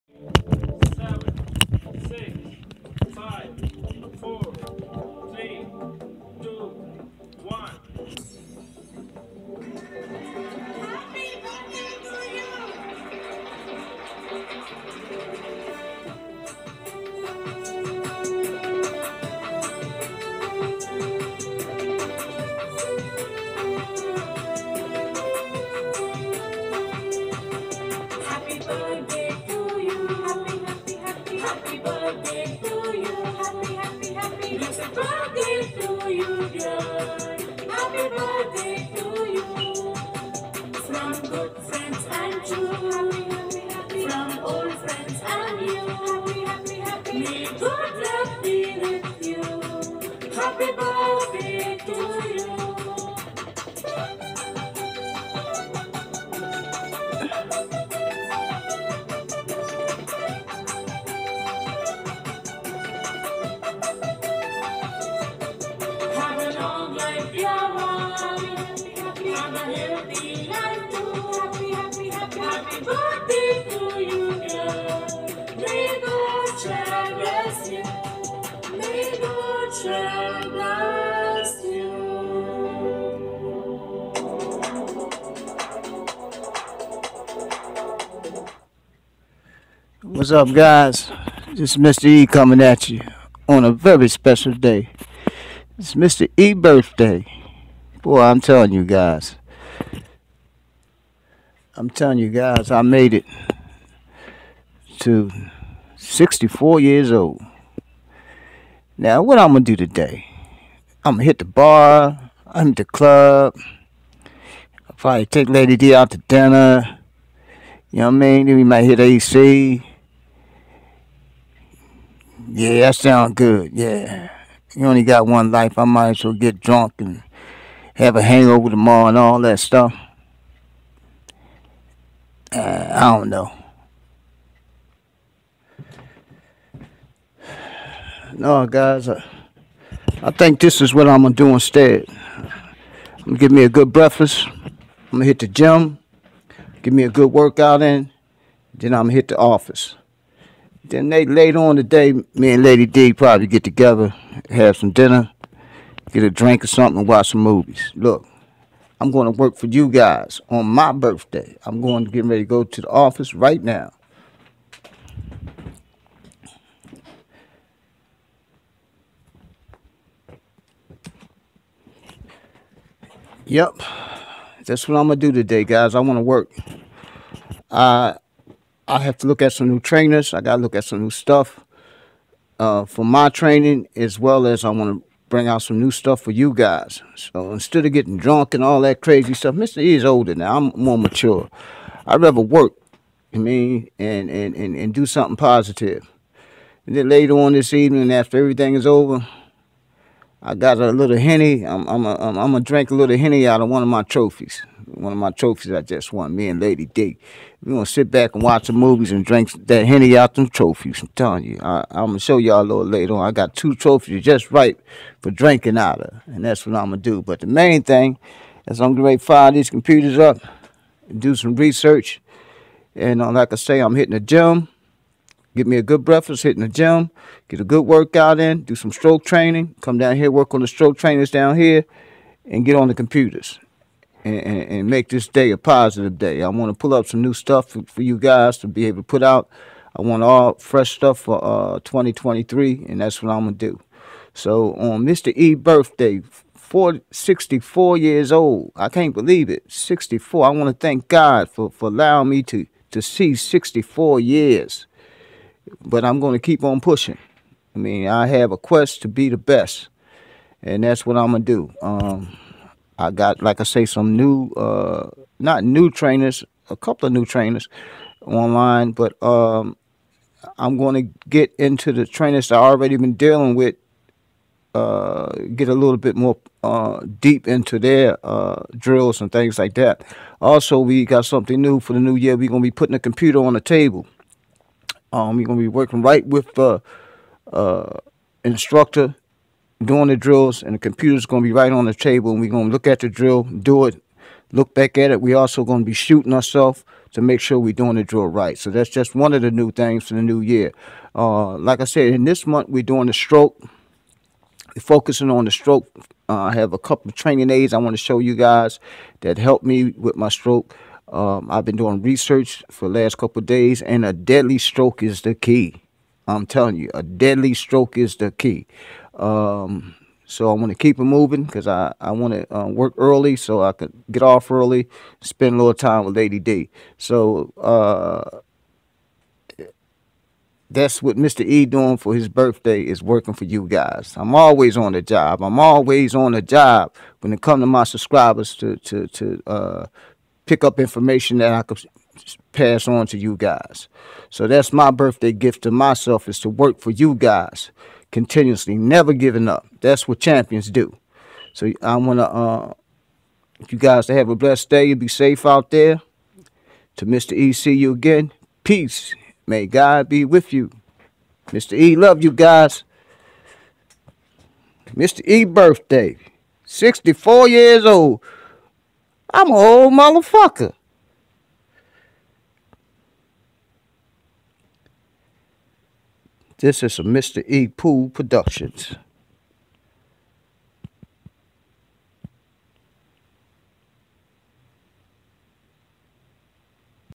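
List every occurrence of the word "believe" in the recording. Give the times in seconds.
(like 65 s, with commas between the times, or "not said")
249 s.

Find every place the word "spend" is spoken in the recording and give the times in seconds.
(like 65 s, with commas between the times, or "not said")
325 s.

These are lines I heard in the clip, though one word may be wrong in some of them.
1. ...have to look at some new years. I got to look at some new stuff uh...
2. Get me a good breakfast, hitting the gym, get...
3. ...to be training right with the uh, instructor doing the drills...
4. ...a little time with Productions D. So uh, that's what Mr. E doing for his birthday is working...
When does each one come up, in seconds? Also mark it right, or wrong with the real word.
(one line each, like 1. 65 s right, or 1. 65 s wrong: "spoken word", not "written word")
1. 178 s wrong: "trainers", not "years"
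2. 225 s right
3. 285 s wrong: "working", not "training"
4. 325 s wrong: "Lady", not "Productions".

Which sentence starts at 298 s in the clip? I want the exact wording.
So that's just one of the new things for the new year.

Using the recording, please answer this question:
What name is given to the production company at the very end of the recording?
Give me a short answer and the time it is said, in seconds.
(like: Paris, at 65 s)
Mr. E Pool Productions, at 377 s.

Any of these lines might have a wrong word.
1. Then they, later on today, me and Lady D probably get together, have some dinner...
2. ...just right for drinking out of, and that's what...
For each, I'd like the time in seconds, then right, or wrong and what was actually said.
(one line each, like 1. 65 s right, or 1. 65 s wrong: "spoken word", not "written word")
1. 150 s right
2. 214 s right.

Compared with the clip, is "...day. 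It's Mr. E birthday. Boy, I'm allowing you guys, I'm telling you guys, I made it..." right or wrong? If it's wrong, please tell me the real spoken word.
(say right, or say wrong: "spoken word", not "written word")
wrong: "telling", not "allowing".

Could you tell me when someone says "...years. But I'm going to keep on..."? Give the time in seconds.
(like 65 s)
254 s.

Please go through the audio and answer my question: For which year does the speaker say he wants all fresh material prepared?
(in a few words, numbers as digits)
2023.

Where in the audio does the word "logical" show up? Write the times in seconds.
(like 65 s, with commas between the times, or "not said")
not said.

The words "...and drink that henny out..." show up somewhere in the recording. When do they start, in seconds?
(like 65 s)
209 s.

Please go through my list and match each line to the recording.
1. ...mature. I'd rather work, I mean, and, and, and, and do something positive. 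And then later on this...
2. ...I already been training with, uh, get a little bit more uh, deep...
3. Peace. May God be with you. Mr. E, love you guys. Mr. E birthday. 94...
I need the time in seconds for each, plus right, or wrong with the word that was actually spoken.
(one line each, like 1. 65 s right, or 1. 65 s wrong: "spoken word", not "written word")
1. 190 s right
2. 272 s wrong: "dealing", not "training"
3. 358 s wrong: "64", not "94".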